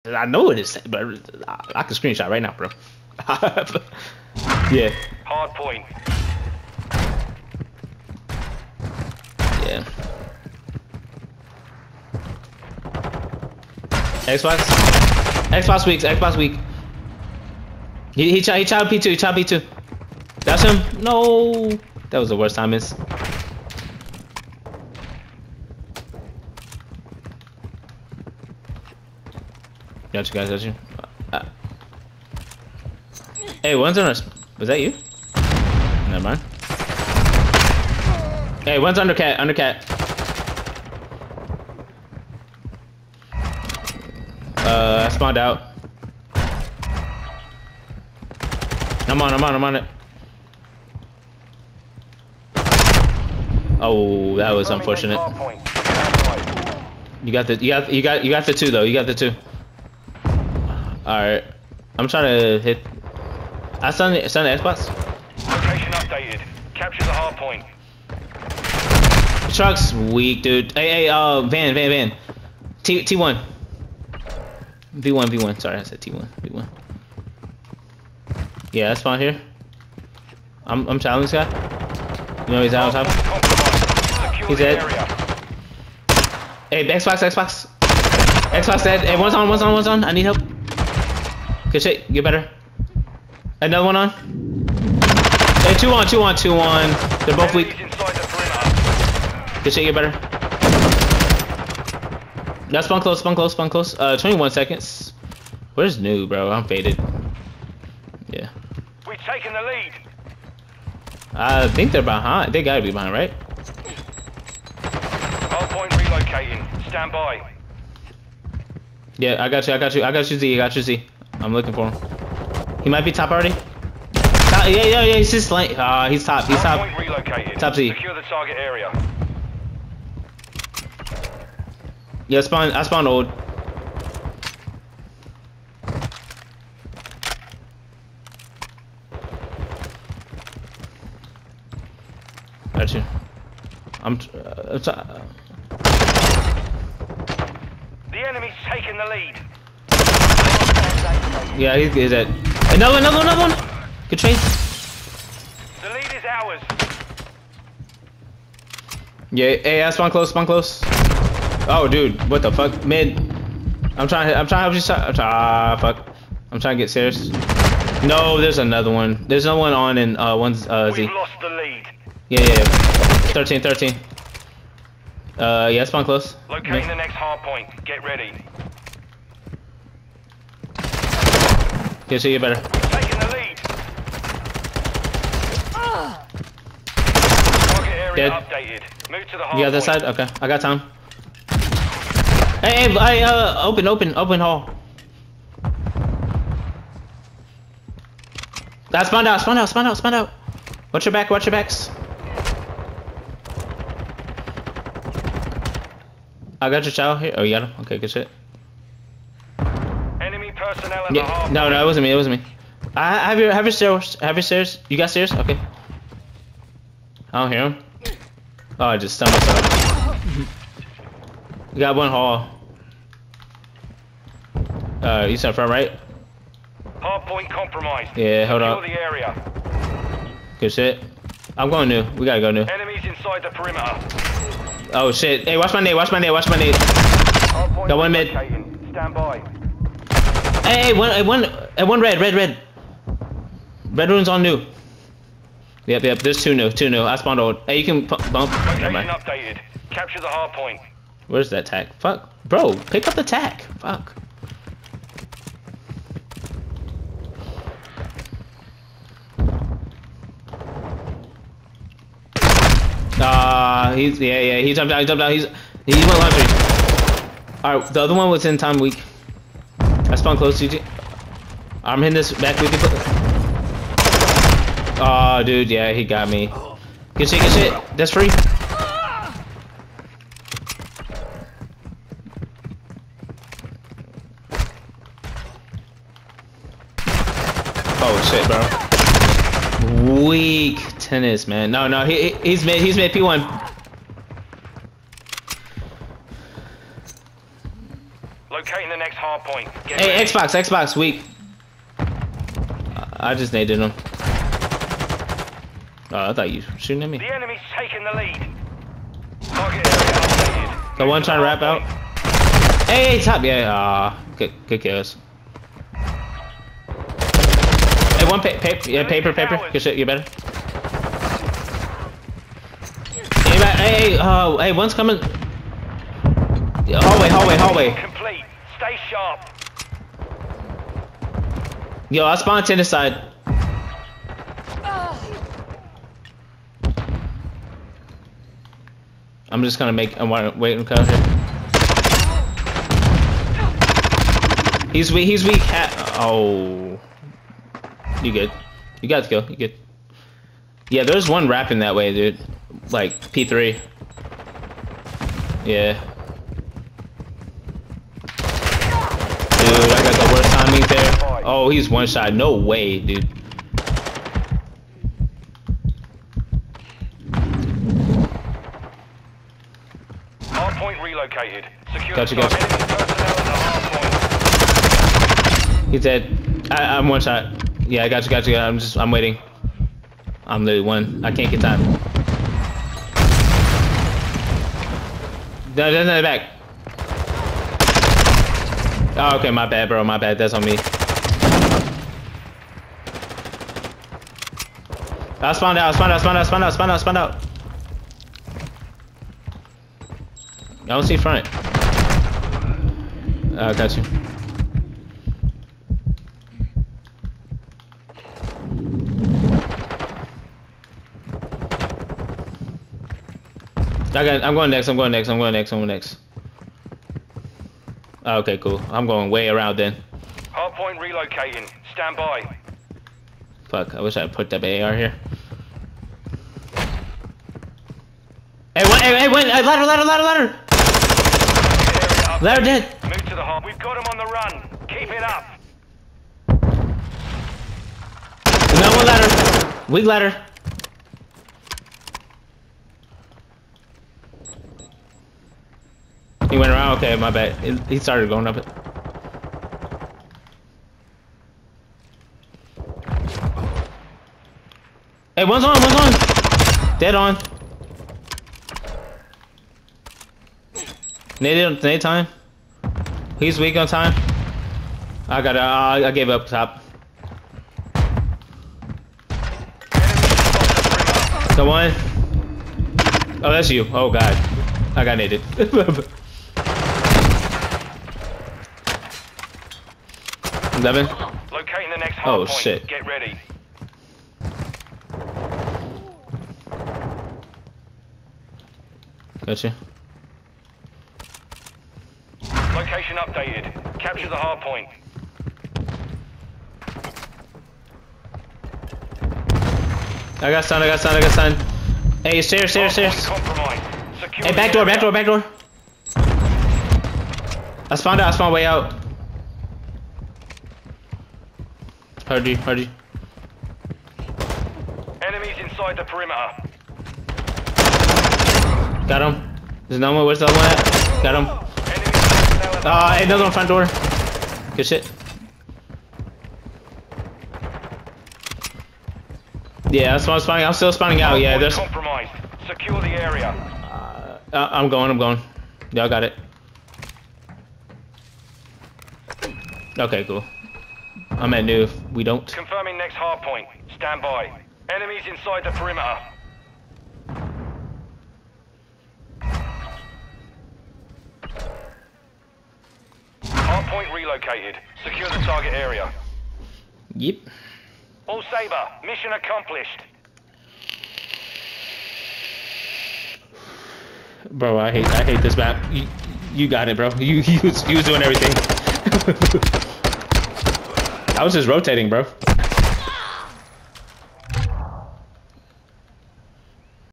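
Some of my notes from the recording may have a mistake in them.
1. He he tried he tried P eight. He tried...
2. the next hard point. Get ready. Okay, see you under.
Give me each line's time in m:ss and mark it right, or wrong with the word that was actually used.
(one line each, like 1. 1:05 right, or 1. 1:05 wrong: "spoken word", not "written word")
1. 0:18 wrong: "two", not "eight"
2. 2:56 wrong: "better", not "under".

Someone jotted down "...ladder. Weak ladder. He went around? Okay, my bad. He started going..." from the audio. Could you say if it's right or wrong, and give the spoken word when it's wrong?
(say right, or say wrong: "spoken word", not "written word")
right.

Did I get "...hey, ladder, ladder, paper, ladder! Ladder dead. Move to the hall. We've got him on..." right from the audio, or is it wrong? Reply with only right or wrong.
wrong.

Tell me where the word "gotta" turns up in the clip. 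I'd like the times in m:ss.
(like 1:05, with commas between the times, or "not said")
1:52, 3:52.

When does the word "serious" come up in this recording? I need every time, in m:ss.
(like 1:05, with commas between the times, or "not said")
2:46.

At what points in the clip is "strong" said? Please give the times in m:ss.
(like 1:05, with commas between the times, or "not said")
not said.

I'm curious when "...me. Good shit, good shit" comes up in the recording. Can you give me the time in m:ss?
4:36.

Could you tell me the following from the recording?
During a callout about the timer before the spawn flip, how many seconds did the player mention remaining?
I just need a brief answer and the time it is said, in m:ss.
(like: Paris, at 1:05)
21, at 1:44.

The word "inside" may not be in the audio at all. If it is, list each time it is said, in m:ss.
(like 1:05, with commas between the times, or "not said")
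3:53, 8:35, 9:05.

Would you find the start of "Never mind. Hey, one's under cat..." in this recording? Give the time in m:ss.
0:36.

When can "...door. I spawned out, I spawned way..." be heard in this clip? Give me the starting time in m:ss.
8:25.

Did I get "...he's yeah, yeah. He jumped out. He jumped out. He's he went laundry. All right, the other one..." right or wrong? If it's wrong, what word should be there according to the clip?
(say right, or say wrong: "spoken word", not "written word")
right.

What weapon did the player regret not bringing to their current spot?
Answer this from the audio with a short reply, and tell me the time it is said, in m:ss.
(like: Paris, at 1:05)
AR, at 7:04.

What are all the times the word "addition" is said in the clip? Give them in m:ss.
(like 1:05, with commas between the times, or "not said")
not said.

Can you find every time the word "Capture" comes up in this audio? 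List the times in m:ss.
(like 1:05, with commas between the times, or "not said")
1:06, 4:09, 8:13.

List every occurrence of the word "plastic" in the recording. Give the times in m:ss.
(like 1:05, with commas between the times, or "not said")
not said.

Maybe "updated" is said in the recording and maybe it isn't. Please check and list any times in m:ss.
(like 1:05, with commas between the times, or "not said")
1:05, 3:08, 4:09, 8:13.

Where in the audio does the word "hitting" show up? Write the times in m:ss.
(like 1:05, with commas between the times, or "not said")
4:32.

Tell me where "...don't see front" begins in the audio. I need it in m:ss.
6:40.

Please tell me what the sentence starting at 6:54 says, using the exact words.
I got, I'm going next, I'm going next, I'm going next, I'm going next.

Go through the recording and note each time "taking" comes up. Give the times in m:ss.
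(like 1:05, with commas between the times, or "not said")
2:28, 3:02, 5:07.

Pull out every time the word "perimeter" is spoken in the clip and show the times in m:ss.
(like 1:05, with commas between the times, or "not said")
3:53, 8:36, 9:05.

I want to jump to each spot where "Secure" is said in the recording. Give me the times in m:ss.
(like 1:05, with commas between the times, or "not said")
2:07, 6:11, 8:52, 9:15.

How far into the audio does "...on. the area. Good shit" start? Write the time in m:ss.
3:48.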